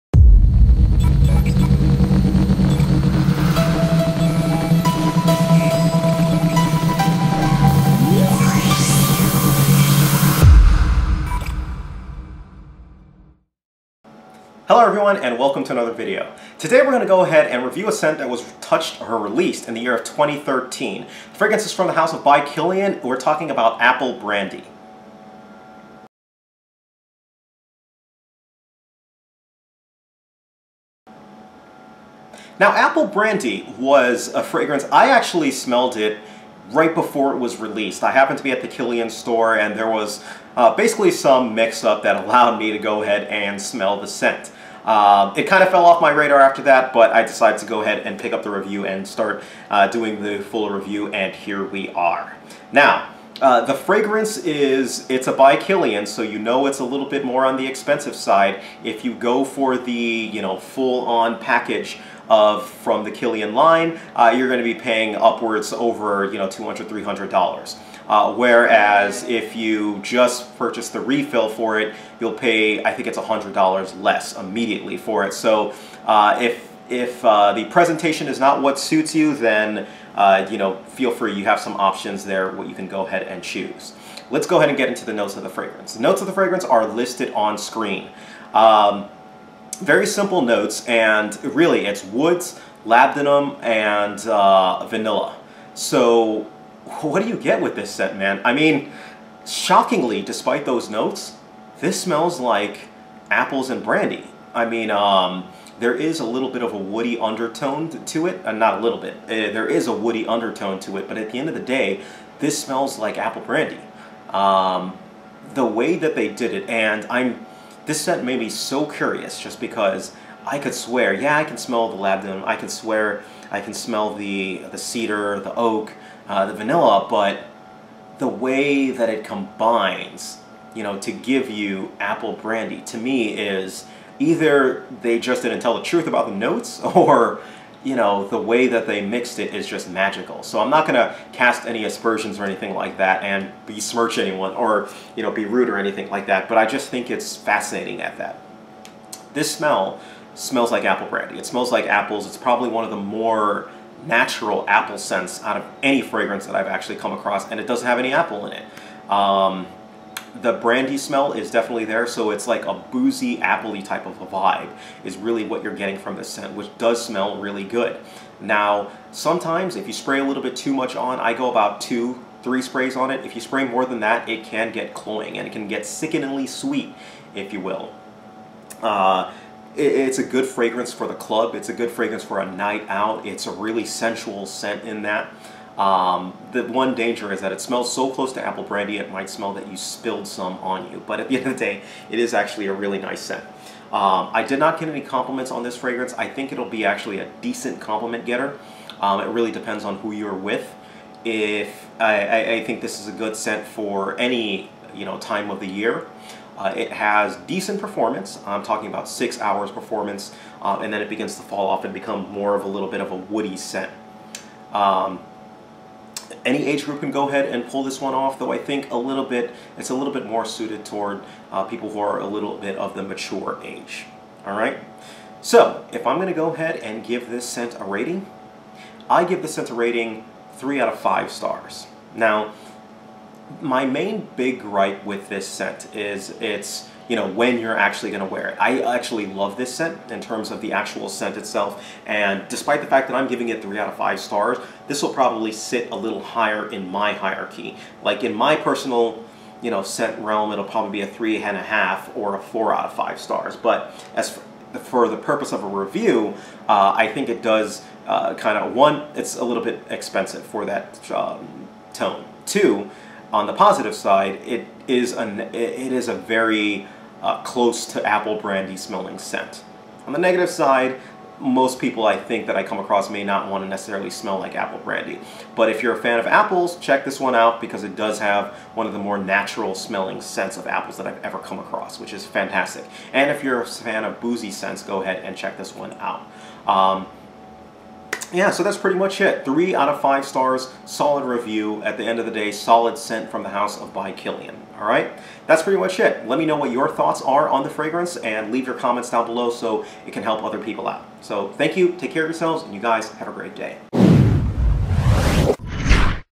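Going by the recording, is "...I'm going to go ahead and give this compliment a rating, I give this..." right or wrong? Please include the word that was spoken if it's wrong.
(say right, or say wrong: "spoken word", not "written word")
wrong: "scent", not "compliment".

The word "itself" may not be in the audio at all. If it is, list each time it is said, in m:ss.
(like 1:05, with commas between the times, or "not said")
4:01.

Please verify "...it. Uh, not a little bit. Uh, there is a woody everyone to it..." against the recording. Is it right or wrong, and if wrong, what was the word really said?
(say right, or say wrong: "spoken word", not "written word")
wrong: "undertone", not "everyone".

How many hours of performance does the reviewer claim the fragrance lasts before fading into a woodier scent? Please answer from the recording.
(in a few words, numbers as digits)
6 hours.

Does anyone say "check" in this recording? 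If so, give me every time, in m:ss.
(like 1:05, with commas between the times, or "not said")
4:36, 4:45.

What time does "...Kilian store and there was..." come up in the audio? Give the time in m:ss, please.
0:38.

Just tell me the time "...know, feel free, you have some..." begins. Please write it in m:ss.
1:20.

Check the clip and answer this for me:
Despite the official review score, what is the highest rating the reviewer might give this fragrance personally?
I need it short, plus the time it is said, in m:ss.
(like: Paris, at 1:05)
4 out of 5 stars, at 4:12.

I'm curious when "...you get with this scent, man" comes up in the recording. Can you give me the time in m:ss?
1:37.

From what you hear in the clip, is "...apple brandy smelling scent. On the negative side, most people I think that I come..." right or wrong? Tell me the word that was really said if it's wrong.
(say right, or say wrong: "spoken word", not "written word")
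right.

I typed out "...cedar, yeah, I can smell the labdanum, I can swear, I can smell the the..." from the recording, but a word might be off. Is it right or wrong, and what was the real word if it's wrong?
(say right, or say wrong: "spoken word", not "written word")
wrong: "swear", not "cedar".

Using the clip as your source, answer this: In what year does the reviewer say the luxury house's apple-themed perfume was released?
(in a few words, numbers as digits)
2013.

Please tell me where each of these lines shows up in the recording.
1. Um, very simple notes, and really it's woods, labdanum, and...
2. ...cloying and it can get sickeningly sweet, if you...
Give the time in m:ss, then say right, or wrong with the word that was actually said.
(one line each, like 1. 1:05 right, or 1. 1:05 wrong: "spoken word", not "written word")
1. 1:28 right
2. 2:54 right.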